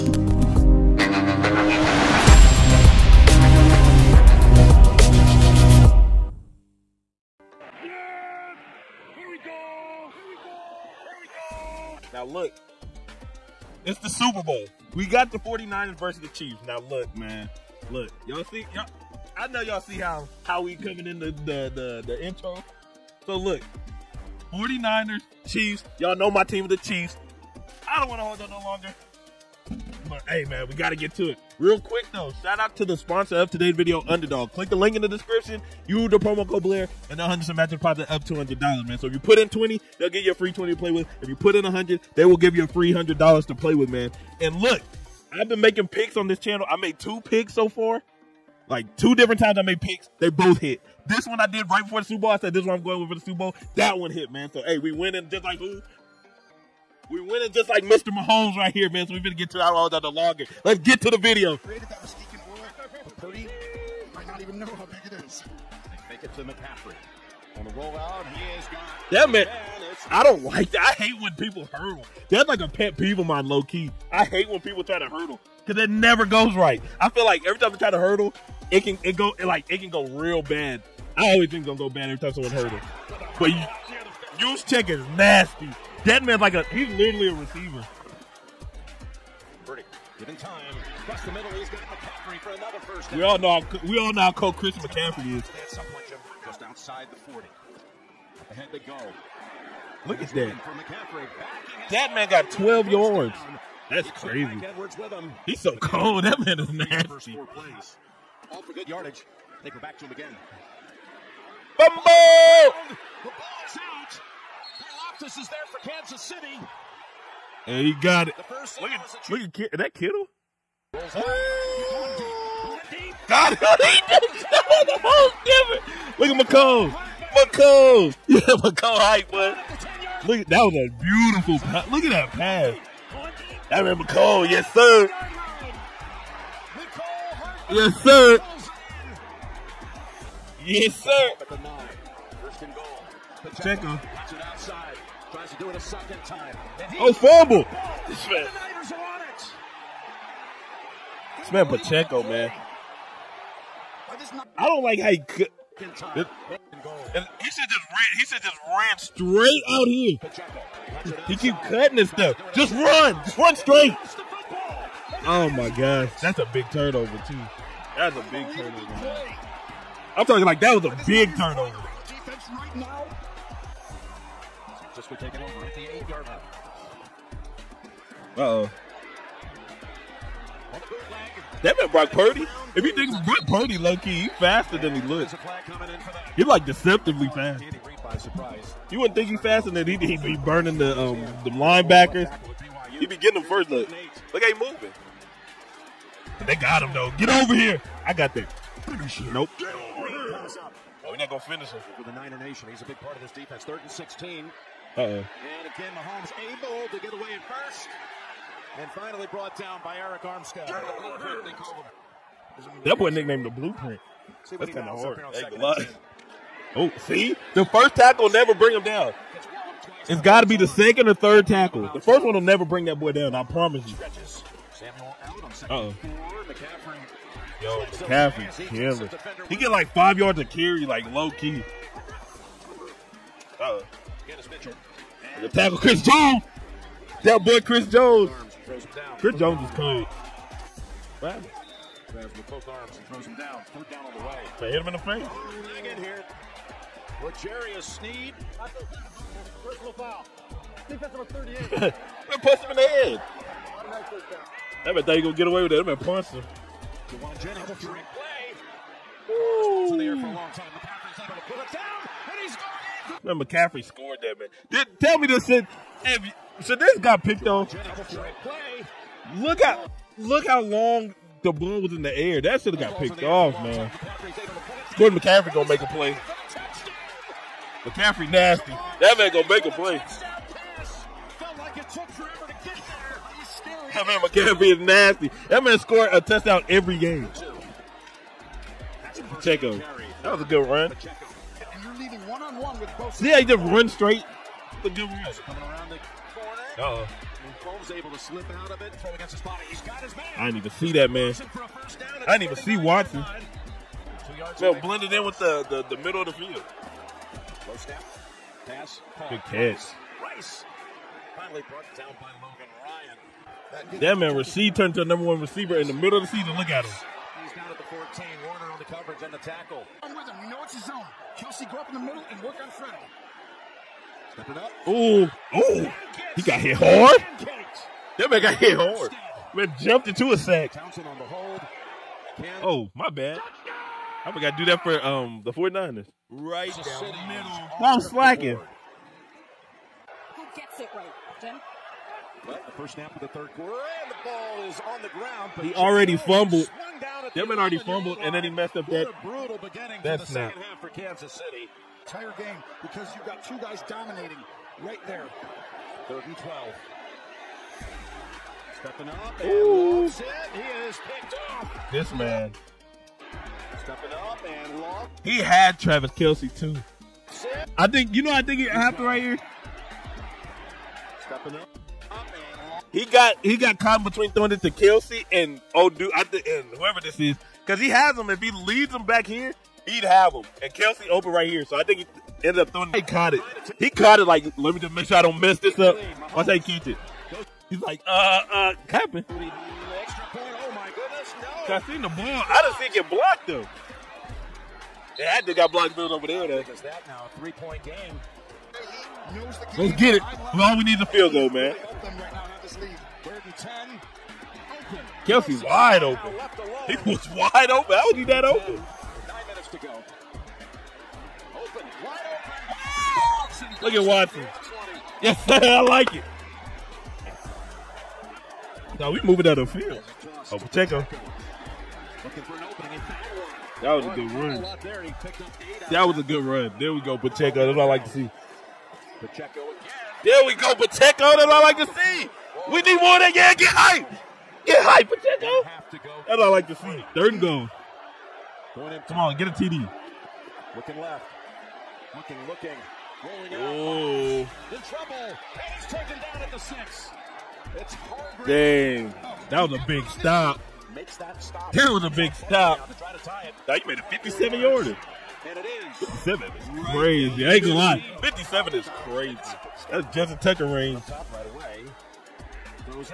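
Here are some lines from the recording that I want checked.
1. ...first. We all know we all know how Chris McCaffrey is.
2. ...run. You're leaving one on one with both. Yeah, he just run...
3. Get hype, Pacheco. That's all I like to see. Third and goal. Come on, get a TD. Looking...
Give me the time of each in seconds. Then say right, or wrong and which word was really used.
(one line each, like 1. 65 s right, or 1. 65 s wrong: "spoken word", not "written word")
1. 92 s right
2. 290 s right
3. 434 s right.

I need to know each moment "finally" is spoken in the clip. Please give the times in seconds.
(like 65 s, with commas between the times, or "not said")
208 s, 311 s.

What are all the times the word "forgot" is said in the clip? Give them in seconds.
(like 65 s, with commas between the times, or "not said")
334 s.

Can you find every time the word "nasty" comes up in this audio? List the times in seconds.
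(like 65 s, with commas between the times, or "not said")
85 s, 106 s, 278 s, 284 s.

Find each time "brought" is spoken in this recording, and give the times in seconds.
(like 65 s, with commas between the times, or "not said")
209 s, 311 s.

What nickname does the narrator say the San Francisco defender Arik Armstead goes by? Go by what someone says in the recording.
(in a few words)
the Blueprint.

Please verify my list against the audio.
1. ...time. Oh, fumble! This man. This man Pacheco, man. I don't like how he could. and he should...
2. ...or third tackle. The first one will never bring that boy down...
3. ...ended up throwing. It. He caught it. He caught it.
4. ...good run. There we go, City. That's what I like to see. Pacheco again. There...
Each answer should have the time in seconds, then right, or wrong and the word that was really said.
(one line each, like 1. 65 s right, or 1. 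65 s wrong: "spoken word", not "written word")
1. 146 s right
2. 221 s right
3. 382 s right
4. 426 s wrong: "Pacheco", not "City".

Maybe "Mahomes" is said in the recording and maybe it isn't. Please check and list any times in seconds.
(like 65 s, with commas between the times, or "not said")
58 s, 205 s.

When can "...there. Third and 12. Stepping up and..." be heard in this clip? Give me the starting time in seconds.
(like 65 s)
355 s.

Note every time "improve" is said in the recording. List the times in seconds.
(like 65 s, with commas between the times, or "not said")
not said.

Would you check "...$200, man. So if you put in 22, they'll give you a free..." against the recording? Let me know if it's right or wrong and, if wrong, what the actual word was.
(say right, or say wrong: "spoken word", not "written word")
wrong: "20", not "22".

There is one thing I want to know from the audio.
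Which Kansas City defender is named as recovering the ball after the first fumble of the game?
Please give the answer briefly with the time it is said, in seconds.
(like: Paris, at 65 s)
Loftus, at 115 s.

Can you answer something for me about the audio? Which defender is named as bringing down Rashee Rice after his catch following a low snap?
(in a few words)
Logan Ryan.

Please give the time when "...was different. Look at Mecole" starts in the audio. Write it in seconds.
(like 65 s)
124 s.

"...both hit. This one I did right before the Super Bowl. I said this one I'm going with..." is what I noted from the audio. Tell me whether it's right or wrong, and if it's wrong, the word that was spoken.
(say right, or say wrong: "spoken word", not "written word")
right.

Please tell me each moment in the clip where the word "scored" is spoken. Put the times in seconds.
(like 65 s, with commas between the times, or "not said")
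263 s, 285 s.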